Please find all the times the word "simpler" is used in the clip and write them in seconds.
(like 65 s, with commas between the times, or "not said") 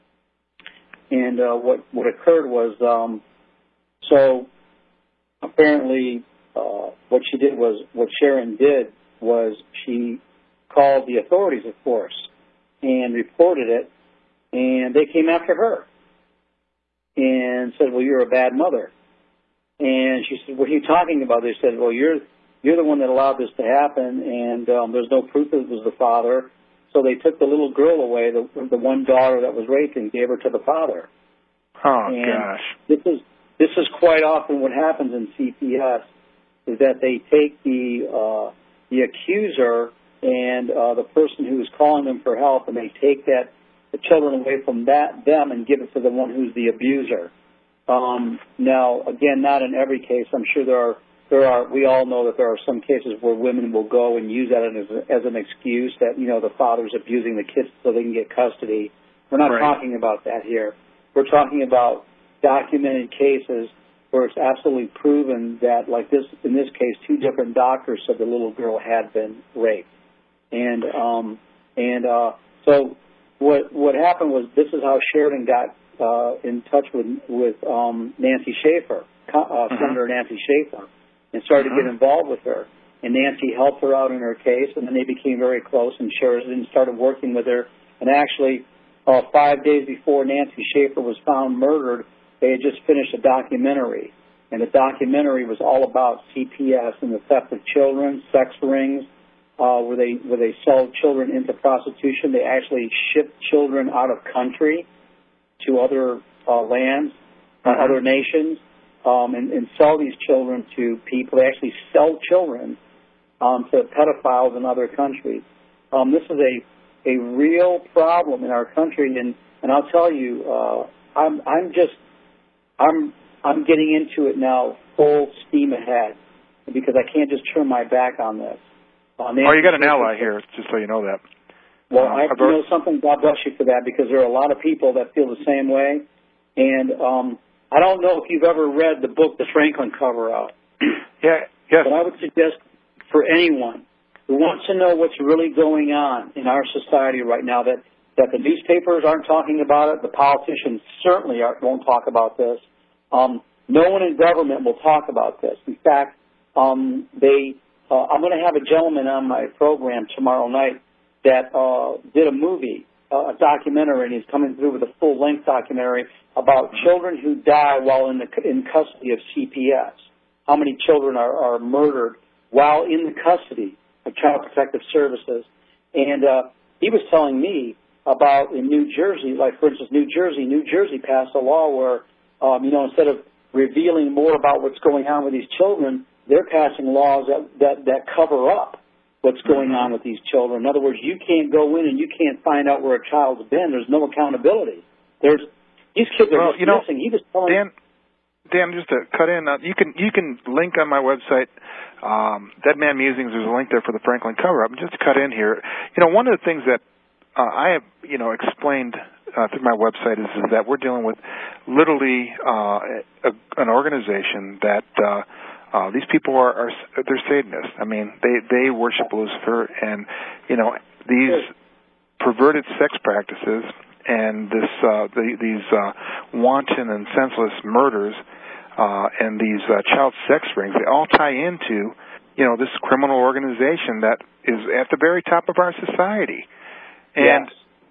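not said.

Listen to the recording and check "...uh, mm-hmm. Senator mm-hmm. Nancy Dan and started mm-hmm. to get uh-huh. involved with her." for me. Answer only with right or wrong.
wrong.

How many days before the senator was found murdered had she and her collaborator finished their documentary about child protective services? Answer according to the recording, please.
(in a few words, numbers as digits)
5.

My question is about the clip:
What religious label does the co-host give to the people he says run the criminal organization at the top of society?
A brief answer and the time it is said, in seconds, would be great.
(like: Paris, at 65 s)
Satanists, at 217 s.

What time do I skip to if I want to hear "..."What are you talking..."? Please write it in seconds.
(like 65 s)
20 s.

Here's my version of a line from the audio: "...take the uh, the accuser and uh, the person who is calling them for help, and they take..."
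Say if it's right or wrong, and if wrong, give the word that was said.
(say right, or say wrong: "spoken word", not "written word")
right.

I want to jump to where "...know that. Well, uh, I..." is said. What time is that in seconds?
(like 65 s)
130 s.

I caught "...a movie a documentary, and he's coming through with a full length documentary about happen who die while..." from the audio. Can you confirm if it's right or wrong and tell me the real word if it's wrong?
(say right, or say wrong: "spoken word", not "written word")
wrong: "children", not "happen".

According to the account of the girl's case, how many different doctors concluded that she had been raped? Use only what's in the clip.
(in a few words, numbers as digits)
2.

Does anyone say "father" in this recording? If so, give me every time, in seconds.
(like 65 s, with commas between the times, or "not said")
25 s, 30 s, 56 s.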